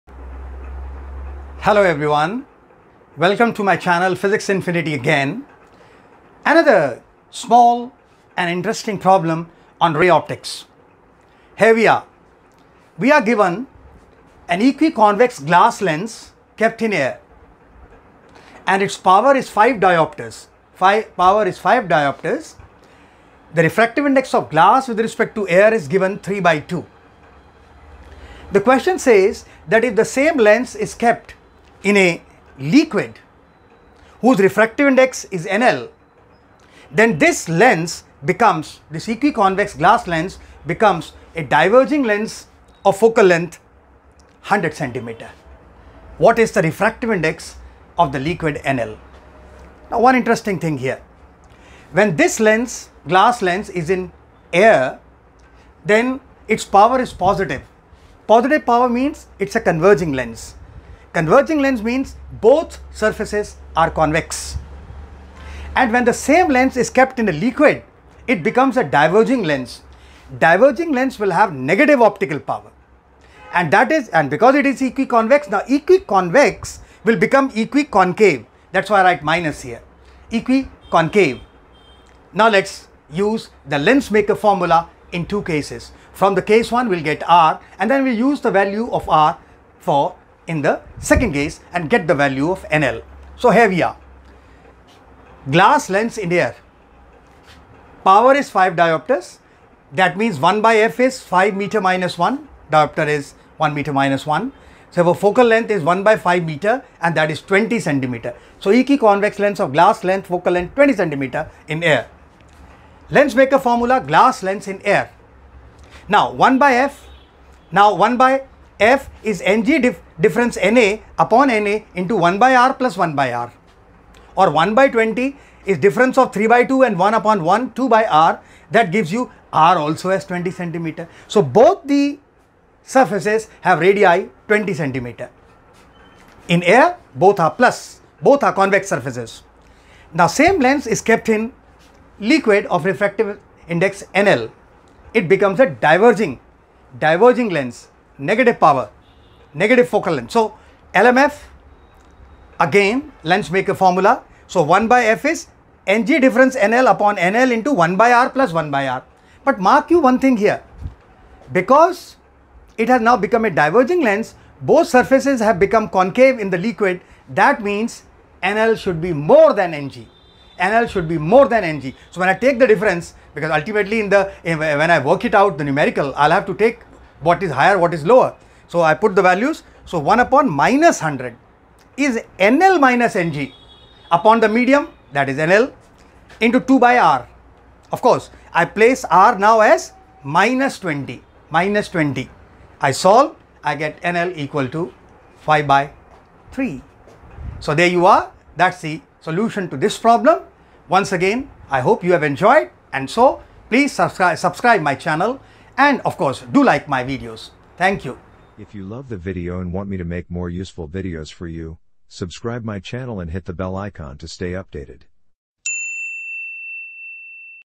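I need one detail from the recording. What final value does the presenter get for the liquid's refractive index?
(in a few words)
5/3.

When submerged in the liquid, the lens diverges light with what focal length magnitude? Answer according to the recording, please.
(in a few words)
100 centimeter.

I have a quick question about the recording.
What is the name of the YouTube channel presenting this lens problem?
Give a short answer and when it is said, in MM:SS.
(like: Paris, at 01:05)
Physics Infinity, at 00:04.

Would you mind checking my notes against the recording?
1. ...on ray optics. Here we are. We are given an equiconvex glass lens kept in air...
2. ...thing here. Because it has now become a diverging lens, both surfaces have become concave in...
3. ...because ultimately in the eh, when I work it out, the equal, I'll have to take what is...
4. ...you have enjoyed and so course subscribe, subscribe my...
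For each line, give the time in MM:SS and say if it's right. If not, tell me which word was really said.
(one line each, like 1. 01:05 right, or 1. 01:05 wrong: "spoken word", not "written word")
1. 00:09 right
2. 02:40 right
3. 02:53 wrong: "numerical", not "equal"
4. 03:22 wrong: "please", not "course".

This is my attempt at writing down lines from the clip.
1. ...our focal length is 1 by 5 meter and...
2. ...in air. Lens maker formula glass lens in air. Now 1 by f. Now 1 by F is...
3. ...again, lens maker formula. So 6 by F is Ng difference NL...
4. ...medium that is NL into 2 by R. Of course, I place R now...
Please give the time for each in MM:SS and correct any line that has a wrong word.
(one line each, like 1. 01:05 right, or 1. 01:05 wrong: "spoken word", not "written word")
1. 01:45 right
2. 01:51 right
3. 02:32 wrong: "1", not "6"
4. 03:04 right.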